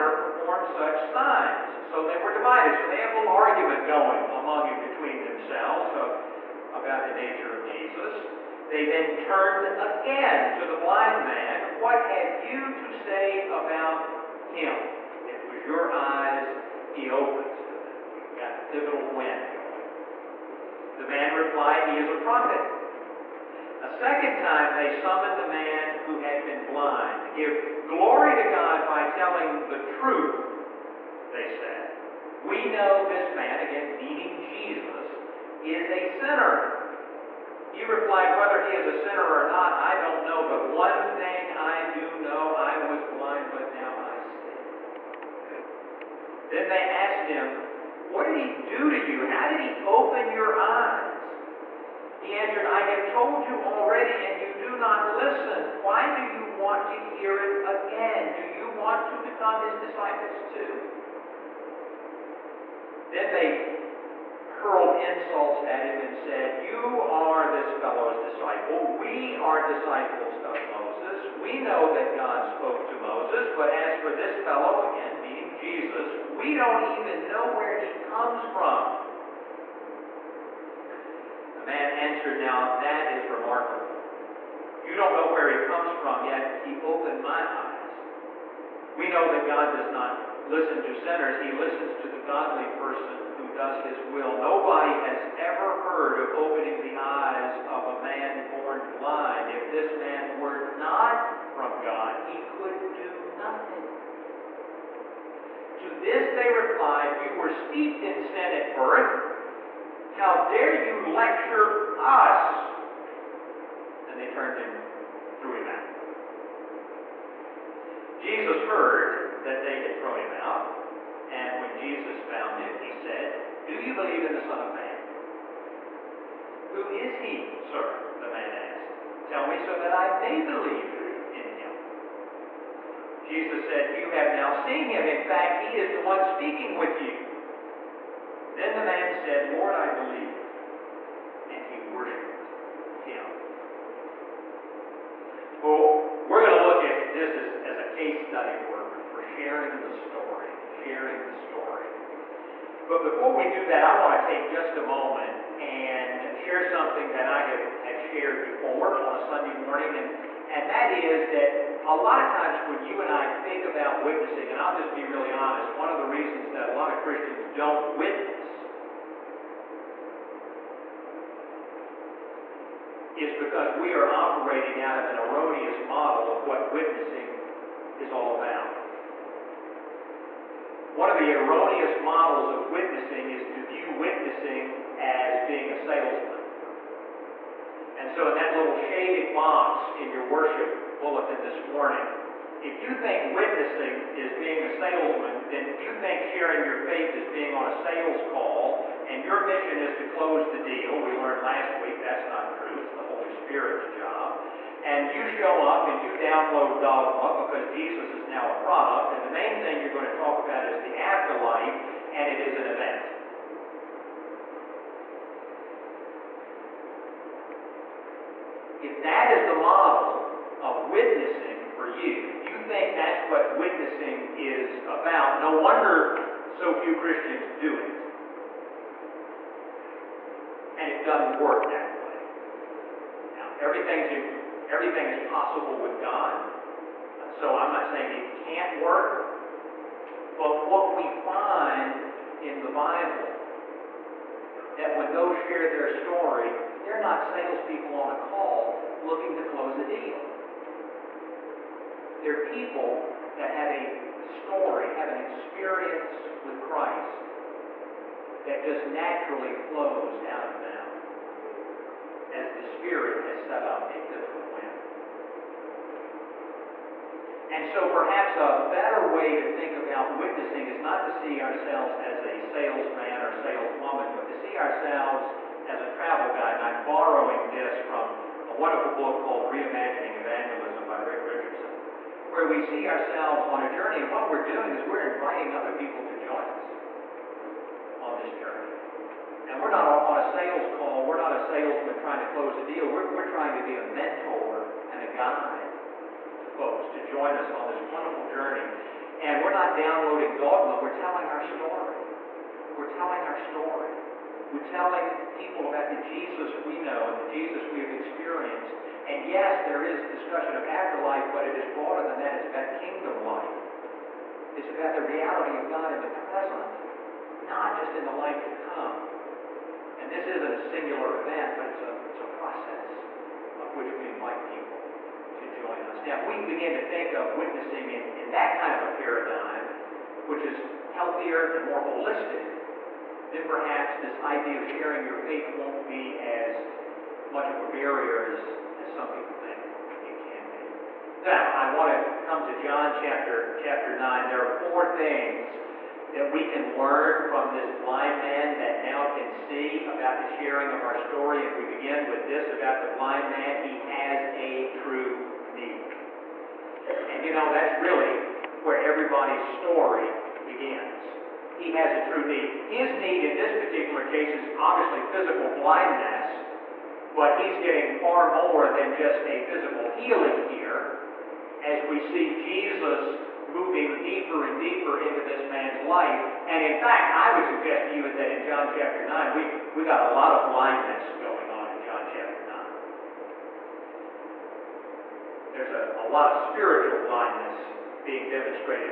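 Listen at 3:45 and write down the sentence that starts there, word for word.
No wonder so few Christians do it.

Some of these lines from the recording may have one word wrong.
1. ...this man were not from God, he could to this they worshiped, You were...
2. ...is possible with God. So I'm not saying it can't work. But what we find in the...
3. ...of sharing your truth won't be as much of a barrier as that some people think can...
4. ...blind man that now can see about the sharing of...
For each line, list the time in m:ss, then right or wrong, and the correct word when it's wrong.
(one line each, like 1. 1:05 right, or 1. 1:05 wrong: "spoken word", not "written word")
1. 1:39 wrong: "replied", not "worshiped"
2. 3:55 right
3. 5:34 wrong: "faith", not "truth"
4. 5:47 right.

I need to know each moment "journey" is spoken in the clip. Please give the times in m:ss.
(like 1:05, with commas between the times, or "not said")
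4:43, 4:48, 4:58.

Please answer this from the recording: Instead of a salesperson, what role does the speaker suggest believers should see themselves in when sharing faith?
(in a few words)
Travel guide.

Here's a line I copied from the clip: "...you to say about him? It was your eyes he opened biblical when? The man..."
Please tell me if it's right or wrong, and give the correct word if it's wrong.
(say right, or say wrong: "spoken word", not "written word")
wrong: "pivotal", not "biblical".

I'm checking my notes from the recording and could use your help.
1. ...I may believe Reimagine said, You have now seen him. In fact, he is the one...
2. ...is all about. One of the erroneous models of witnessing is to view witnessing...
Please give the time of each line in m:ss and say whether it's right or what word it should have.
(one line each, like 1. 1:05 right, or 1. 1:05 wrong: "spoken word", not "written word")
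1. 2:09 wrong: "Jesus", not "Reimagine"
2. 2:58 right.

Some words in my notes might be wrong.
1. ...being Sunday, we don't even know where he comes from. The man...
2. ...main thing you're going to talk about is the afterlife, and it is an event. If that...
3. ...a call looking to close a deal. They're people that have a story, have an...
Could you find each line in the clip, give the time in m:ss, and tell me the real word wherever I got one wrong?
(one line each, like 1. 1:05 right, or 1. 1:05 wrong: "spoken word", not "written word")
1. 1:15 wrong: "Jesus", not "Sunday"
2. 3:29 right
3. 4:08 right.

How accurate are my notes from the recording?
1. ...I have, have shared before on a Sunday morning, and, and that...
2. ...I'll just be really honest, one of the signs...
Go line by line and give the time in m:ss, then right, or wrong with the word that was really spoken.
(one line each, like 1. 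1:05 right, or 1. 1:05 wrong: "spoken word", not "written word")
1. 2:37 right
2. 2:44 wrong: "reasons", not "signs".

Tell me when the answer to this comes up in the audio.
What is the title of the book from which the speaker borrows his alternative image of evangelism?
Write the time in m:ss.
4:39.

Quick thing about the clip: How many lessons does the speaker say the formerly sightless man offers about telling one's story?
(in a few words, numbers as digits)
4.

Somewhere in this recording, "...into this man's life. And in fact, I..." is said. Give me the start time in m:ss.
6:15.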